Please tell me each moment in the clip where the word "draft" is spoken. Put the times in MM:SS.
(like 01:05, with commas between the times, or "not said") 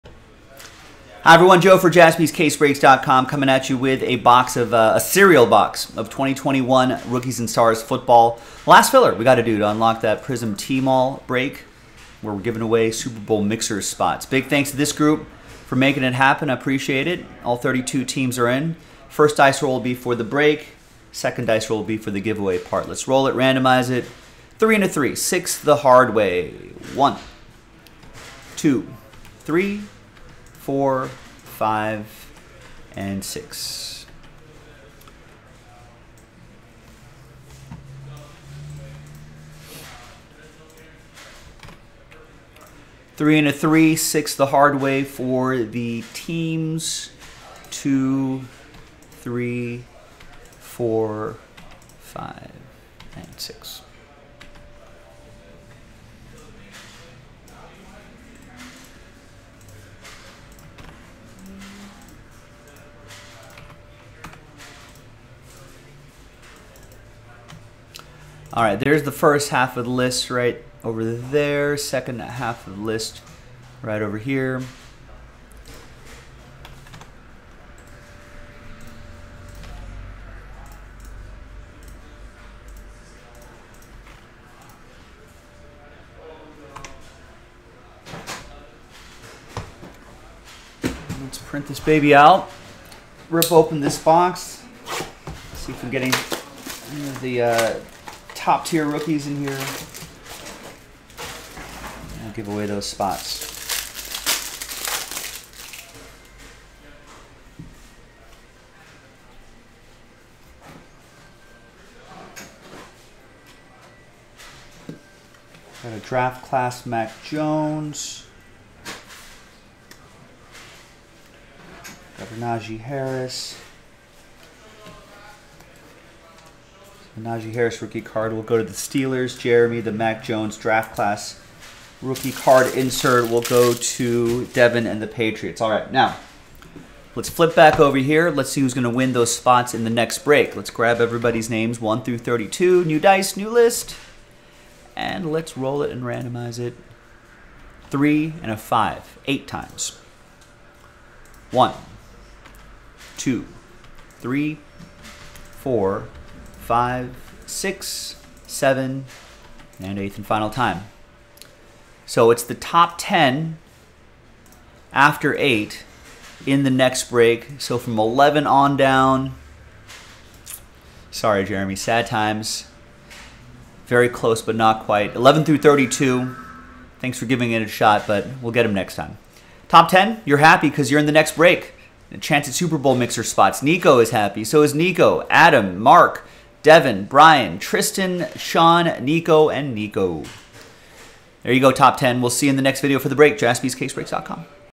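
01:55, 02:10.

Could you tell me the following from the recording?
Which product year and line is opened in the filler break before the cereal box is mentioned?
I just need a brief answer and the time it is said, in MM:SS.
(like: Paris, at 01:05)
2021 Rookies and Stars, at 00:06.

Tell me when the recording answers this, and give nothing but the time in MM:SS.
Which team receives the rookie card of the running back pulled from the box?
02:08.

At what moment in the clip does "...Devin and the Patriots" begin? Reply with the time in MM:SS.
02:14.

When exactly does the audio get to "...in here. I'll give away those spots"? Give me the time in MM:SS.
01:39.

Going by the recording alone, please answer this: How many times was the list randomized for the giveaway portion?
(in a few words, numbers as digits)
8.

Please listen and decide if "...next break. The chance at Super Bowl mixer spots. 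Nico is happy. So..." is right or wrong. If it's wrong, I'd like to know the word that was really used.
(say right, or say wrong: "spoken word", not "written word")
right.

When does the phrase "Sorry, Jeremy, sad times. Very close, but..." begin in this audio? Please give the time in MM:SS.
02:51.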